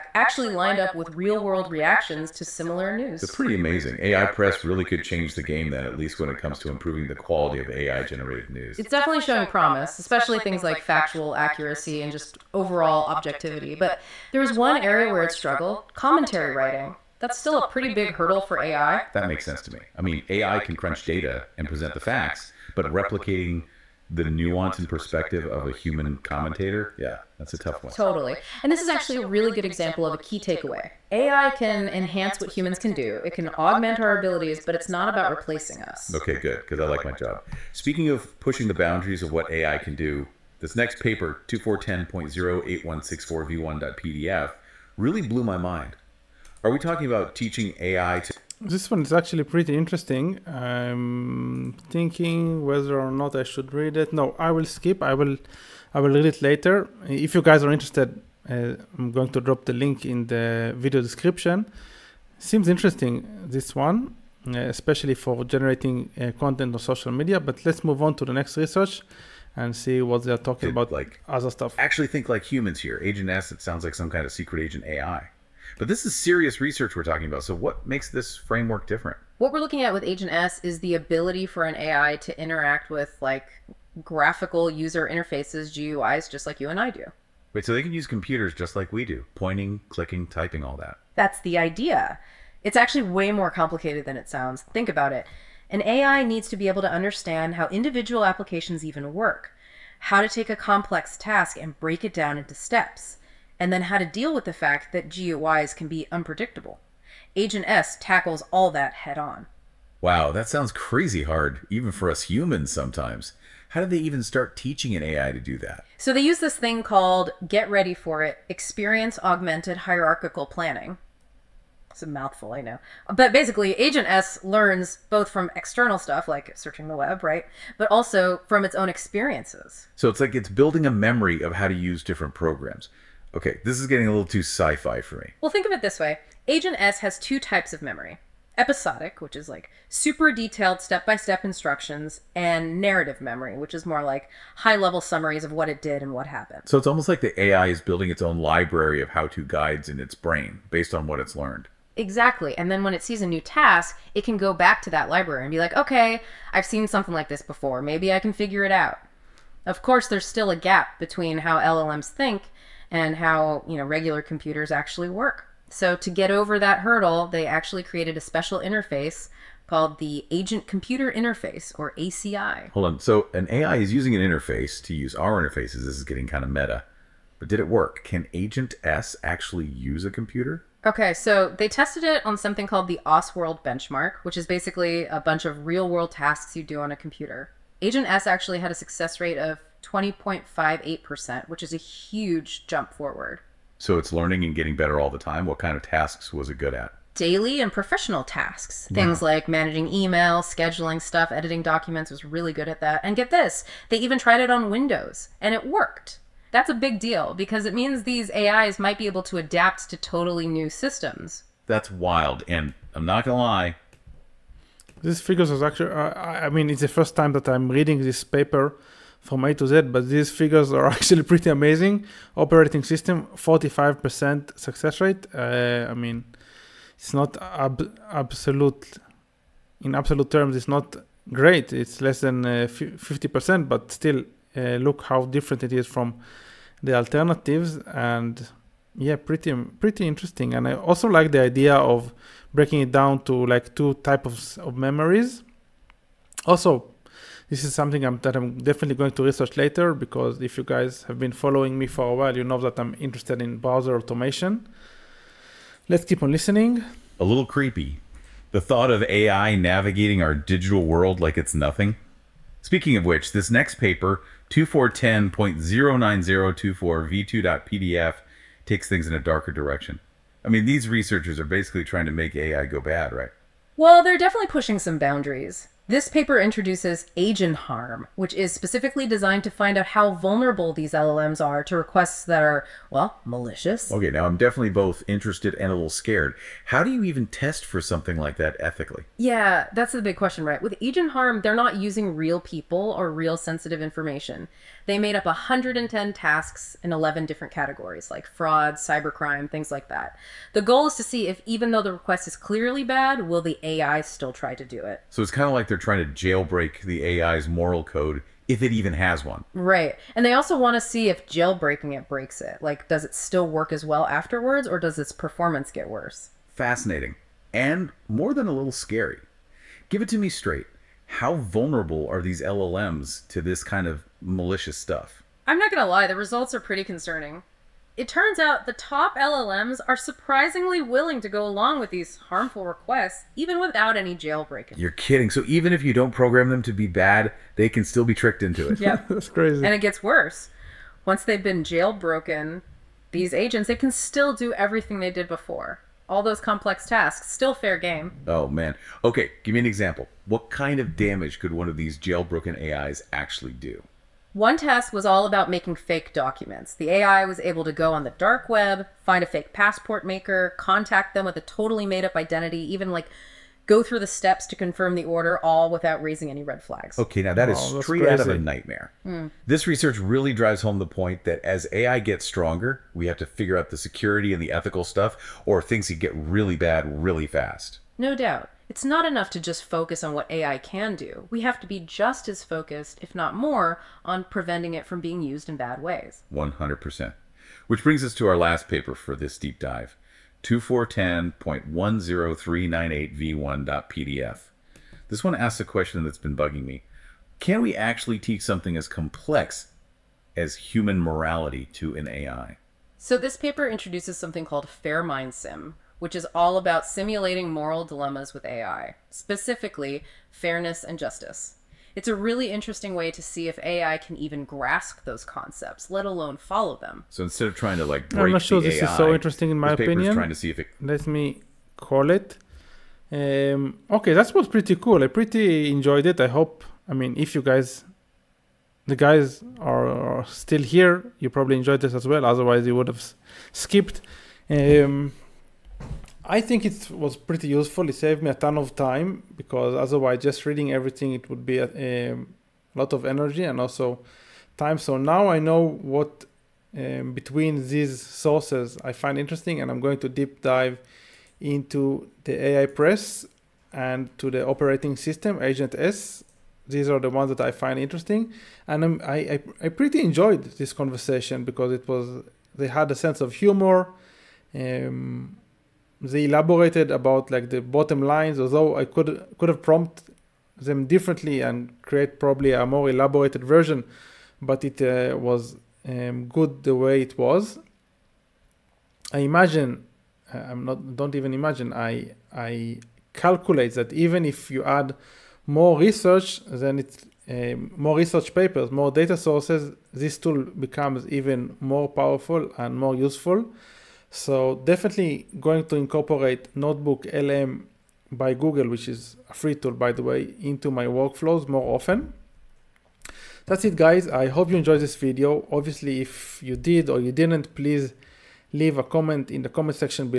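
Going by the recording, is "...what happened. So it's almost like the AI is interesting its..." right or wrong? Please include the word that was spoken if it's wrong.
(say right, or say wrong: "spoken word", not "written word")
wrong: "building", not "interesting".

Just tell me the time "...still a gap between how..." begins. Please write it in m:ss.
2:40.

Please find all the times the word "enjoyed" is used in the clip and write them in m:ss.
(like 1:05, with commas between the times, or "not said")
7:05, 7:11, 7:40, 8:24.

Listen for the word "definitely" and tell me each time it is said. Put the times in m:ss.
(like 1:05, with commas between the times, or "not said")
0:08, 4:08, 4:34, 4:44, 8:14.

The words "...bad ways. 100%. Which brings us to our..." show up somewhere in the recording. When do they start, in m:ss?
6:25.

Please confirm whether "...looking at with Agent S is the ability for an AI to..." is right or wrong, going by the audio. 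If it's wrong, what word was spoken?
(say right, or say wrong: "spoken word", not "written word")
right.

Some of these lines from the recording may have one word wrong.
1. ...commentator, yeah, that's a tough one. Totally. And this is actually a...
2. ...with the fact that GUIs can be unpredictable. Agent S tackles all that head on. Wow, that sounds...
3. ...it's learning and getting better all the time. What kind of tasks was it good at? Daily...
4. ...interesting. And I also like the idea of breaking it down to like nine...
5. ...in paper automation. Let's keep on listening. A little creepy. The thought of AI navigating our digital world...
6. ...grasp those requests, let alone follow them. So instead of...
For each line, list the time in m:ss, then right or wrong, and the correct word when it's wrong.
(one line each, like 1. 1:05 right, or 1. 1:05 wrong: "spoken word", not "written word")
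1. 0:26 right
2. 1:44 right
3. 3:13 right
4. 4:00 wrong: "two", not "nine"
5. 4:13 wrong: "browser", not "paper"
6. 6:54 wrong: "concepts", not "requests".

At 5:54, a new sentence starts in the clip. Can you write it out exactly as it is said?
One test was all about making fake documents.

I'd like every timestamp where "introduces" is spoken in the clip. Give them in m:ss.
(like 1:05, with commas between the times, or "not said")
4:36, 6:43.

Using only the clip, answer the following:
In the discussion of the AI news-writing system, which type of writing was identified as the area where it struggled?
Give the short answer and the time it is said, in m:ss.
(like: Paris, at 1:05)
Commentary writing, at 0:15.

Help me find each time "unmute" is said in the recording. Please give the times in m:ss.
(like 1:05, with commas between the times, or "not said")
not said.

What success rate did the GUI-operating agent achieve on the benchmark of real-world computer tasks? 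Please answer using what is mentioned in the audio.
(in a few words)
20.58%.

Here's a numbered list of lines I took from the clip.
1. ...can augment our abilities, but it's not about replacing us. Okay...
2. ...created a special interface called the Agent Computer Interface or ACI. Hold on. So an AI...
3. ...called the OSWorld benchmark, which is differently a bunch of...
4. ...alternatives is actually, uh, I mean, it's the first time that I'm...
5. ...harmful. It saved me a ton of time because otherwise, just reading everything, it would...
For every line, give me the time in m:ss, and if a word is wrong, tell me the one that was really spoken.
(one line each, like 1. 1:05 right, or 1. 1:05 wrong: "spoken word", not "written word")
1. 0:33 right
2. 2:47 right
3. 3:02 wrong: "basically", not "differently"
4. 3:35 wrong: "figures", not "alternatives"
5. 7:17 wrong: "useful", not "harmful".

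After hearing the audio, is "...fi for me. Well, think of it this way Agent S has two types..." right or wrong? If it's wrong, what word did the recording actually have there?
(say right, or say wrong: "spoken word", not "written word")
right.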